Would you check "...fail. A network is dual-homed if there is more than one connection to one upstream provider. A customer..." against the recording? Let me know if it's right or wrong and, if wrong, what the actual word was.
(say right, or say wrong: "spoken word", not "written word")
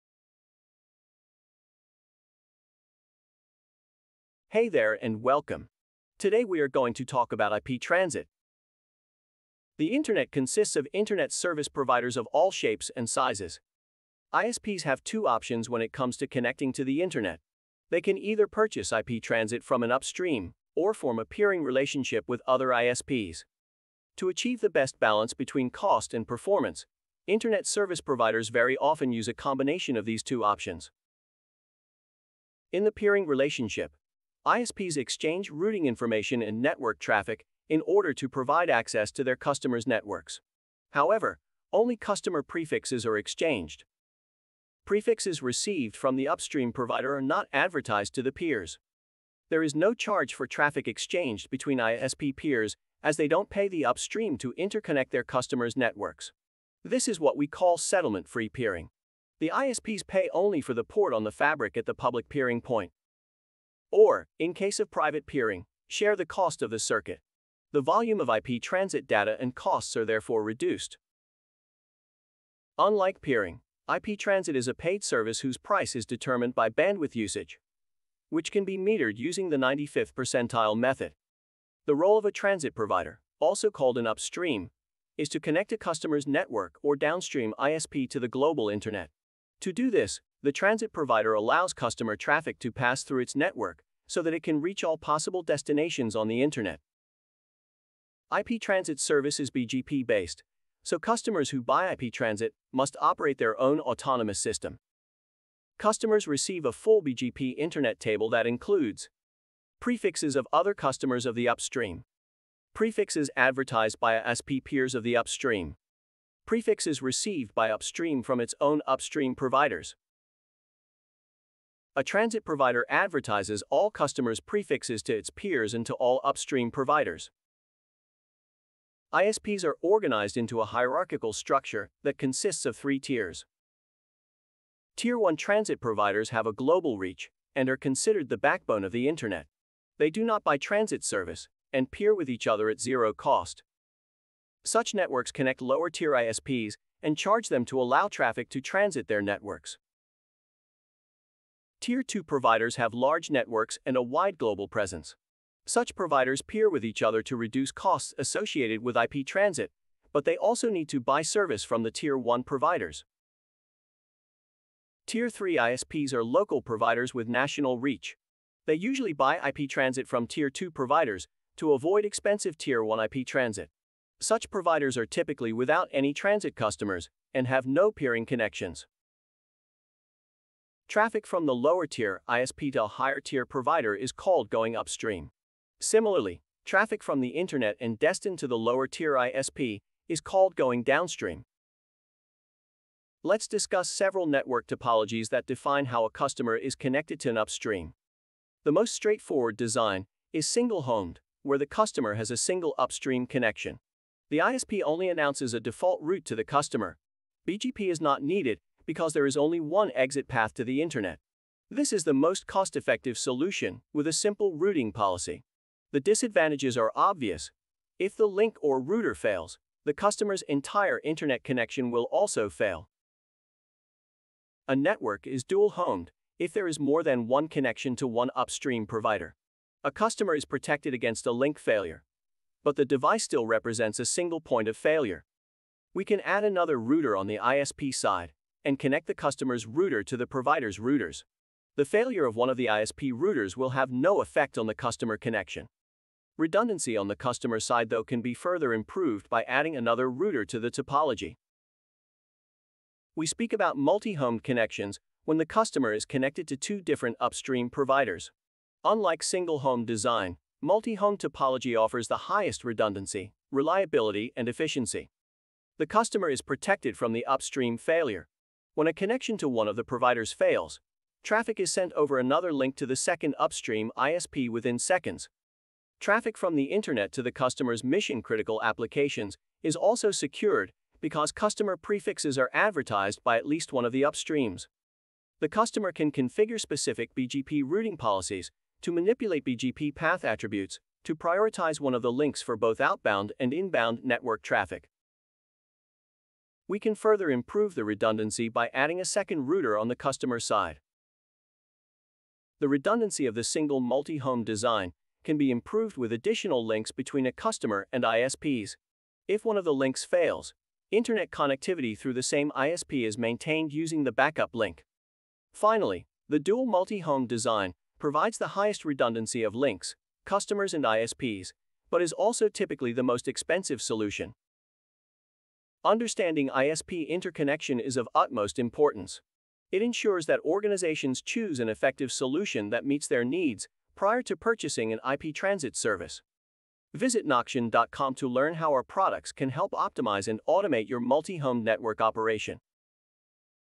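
right.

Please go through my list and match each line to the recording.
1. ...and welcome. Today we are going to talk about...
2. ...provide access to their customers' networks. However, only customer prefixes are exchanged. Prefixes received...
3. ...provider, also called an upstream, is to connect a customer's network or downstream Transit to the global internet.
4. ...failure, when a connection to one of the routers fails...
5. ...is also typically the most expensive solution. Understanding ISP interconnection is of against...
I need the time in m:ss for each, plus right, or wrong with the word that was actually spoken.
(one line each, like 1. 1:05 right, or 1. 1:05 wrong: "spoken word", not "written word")
1. 0:05 right
2. 0:38 right
3. 1:22 wrong: "ISP", not "Transit"
4. 4:27 wrong: "providers", not "routers"
5. 5:22 wrong: "utmost", not "against".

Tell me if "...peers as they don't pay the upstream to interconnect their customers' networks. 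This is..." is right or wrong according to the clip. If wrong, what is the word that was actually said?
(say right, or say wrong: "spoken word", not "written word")
right.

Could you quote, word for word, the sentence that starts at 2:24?
Such networks connect lower tier ISPs and charge them to allow traffic to transit their networks.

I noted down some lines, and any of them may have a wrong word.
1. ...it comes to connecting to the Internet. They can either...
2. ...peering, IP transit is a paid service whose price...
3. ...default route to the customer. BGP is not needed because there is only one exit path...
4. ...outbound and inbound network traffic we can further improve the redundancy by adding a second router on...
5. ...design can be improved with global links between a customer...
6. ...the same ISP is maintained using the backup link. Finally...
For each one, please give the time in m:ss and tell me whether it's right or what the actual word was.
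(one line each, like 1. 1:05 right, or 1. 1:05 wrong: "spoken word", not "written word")
1. 0:15 right
2. 1:13 right
3. 3:25 right
4. 4:52 right
5. 5:04 wrong: "additional", not "global"
6. 5:12 right.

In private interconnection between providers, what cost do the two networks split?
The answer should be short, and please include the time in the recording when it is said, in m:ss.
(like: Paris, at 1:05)
the circuit, at 1:06.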